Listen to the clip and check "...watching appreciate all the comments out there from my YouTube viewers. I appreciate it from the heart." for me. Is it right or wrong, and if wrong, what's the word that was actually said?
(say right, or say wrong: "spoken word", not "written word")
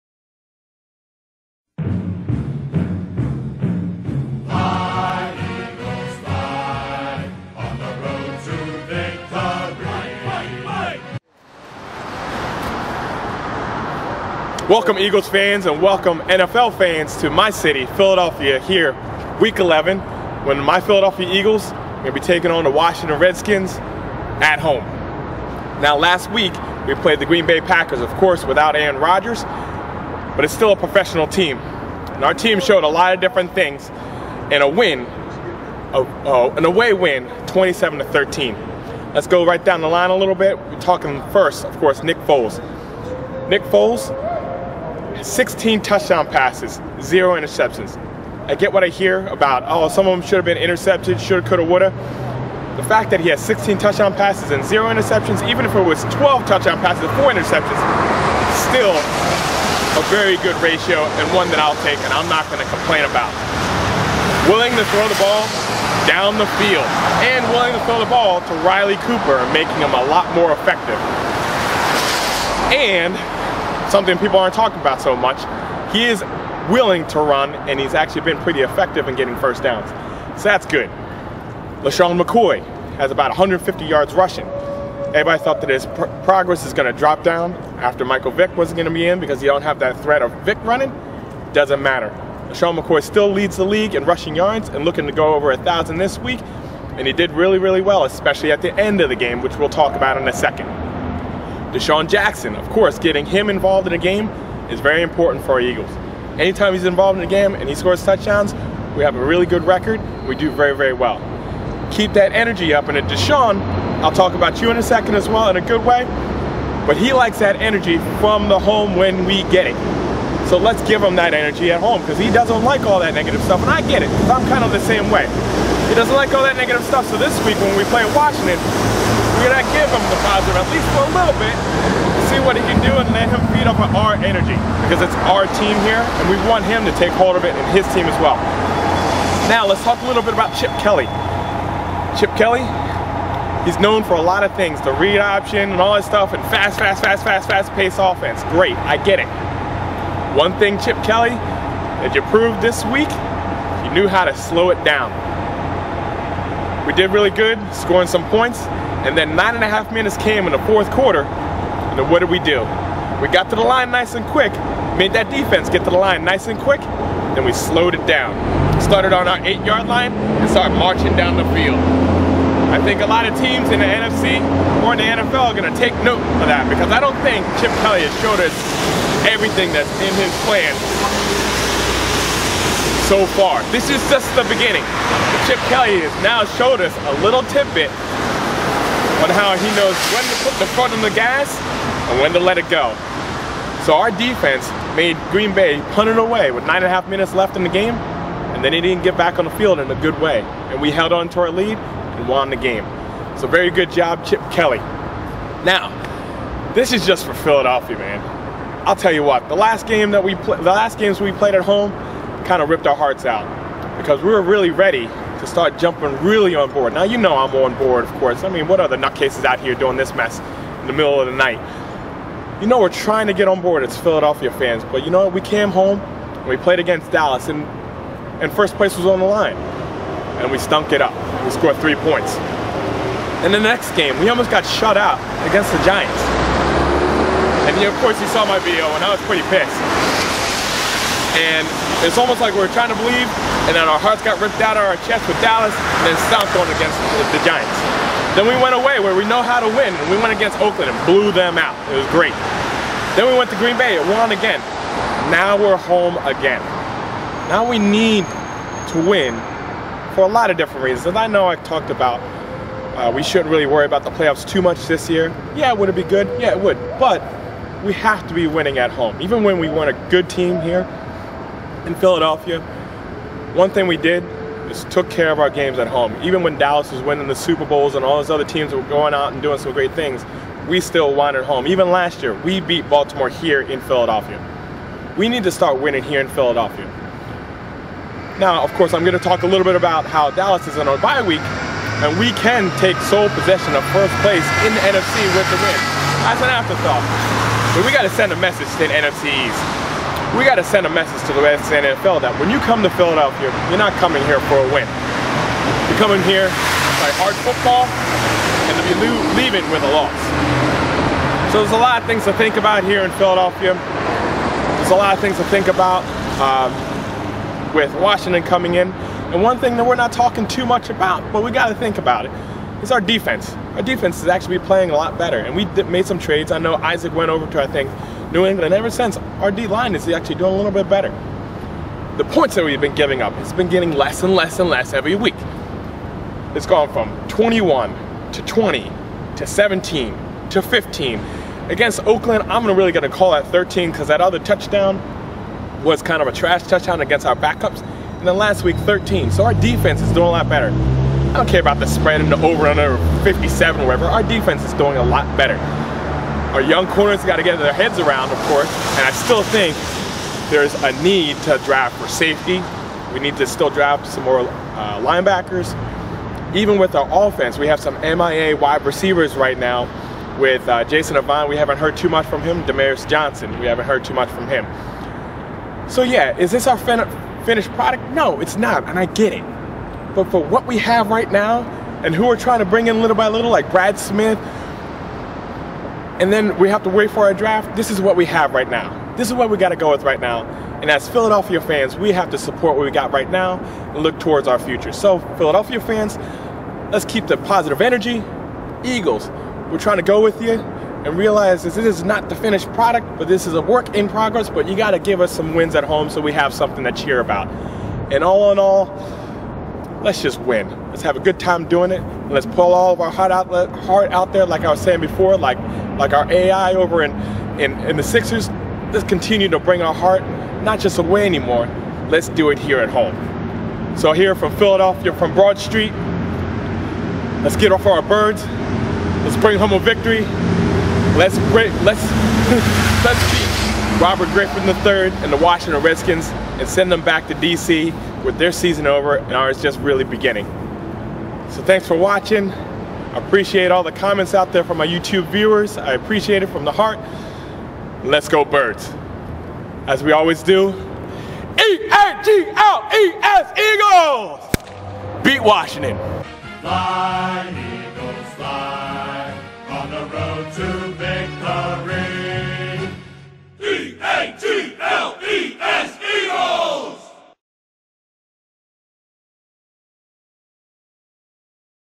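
right.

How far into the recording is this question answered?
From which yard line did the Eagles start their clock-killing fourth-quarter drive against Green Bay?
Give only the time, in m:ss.
2:49.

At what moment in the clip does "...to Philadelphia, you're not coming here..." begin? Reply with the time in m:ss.
5:02.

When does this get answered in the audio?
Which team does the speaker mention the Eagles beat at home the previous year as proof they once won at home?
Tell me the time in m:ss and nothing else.
4:42.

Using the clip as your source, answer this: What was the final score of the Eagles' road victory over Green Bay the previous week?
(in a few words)
27 to 13.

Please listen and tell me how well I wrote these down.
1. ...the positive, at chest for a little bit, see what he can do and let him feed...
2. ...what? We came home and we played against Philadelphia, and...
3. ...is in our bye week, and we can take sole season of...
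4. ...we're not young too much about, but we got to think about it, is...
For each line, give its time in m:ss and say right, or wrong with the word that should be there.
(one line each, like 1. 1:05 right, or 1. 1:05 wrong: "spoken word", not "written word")
1. 2:10 wrong: "least", not "chest"
2. 3:45 wrong: "Dallas", not "Philadelphia"
3. 4:50 wrong: "possession", not "season"
4. 5:19 wrong: "talking", not "young".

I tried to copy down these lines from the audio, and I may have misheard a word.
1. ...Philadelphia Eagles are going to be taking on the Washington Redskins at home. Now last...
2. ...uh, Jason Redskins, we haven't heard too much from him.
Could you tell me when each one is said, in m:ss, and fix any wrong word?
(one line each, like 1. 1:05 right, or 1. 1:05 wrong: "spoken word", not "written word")
1. 0:20 right
2. 6:10 wrong: "Avant", not "Redskins".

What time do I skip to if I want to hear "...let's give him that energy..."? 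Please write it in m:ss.
2:00.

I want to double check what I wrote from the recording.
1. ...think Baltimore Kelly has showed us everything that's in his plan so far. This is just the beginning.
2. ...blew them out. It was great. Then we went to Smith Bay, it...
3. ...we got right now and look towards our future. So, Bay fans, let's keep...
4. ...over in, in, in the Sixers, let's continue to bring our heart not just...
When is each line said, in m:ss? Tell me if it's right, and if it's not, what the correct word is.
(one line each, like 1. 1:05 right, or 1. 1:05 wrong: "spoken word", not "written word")
1. 2:57 wrong: "Chip", not "Baltimore"
2. 4:11 wrong: "Green", not "Smith"
3. 6:32 wrong: "Philadelphia", not "Bay"
4. 6:56 right.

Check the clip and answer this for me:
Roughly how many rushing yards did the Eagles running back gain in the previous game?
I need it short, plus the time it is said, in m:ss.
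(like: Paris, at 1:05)
About 150, at 1:23.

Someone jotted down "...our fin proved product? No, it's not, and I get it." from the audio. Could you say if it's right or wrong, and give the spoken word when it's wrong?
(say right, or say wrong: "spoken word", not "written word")
wrong: "finished", not "proved".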